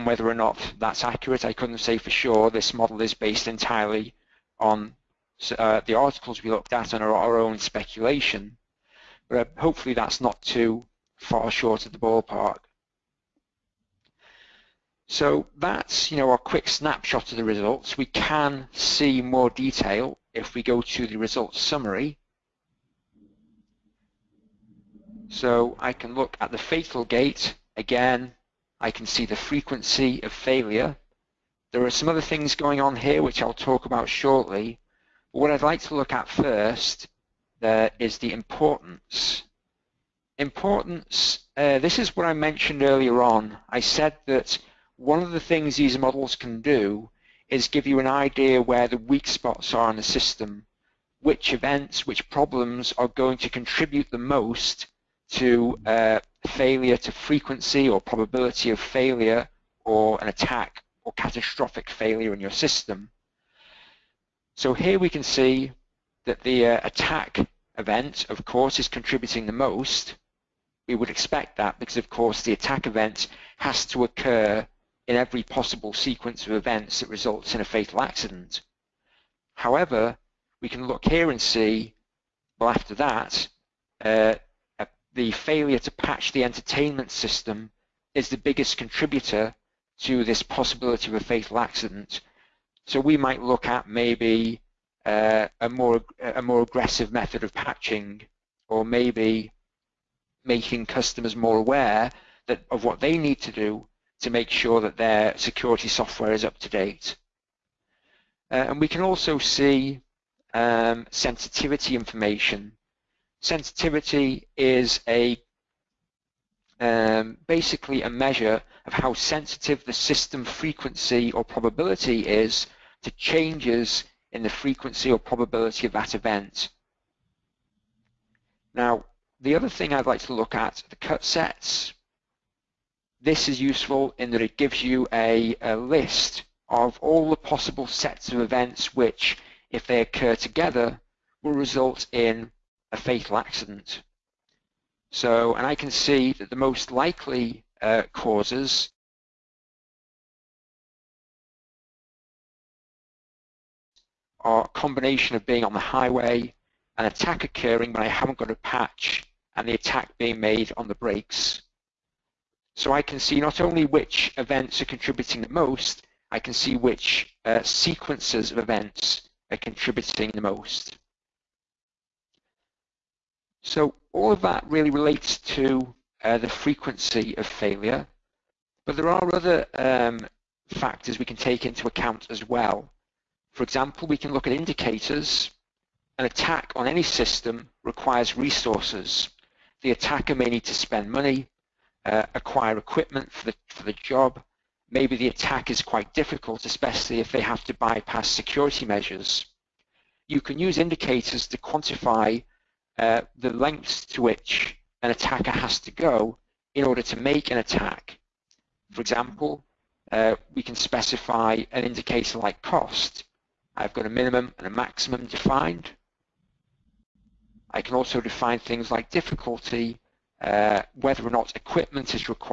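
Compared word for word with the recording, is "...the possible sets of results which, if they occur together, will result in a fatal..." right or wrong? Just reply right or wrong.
wrong.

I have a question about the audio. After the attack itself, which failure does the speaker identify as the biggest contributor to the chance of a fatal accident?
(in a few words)
Failure to patch the entertainment system.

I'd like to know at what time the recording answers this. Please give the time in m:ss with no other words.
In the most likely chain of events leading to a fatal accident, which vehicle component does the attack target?
2:40.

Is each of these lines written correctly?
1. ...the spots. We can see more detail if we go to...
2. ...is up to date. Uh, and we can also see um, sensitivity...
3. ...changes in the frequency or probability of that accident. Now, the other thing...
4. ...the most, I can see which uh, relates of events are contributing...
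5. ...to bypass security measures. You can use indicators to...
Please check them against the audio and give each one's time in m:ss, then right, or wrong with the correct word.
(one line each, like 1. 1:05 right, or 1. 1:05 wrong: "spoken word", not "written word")
1. 0:17 wrong: "results", not "spots"
2. 1:46 right
3. 2:03 wrong: "event", not "accident"
4. 2:45 wrong: "sequences", not "relates"
5. 3:17 right.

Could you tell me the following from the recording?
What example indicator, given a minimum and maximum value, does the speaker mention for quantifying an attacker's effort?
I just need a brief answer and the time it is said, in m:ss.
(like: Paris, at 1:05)
Cost, at 3:32.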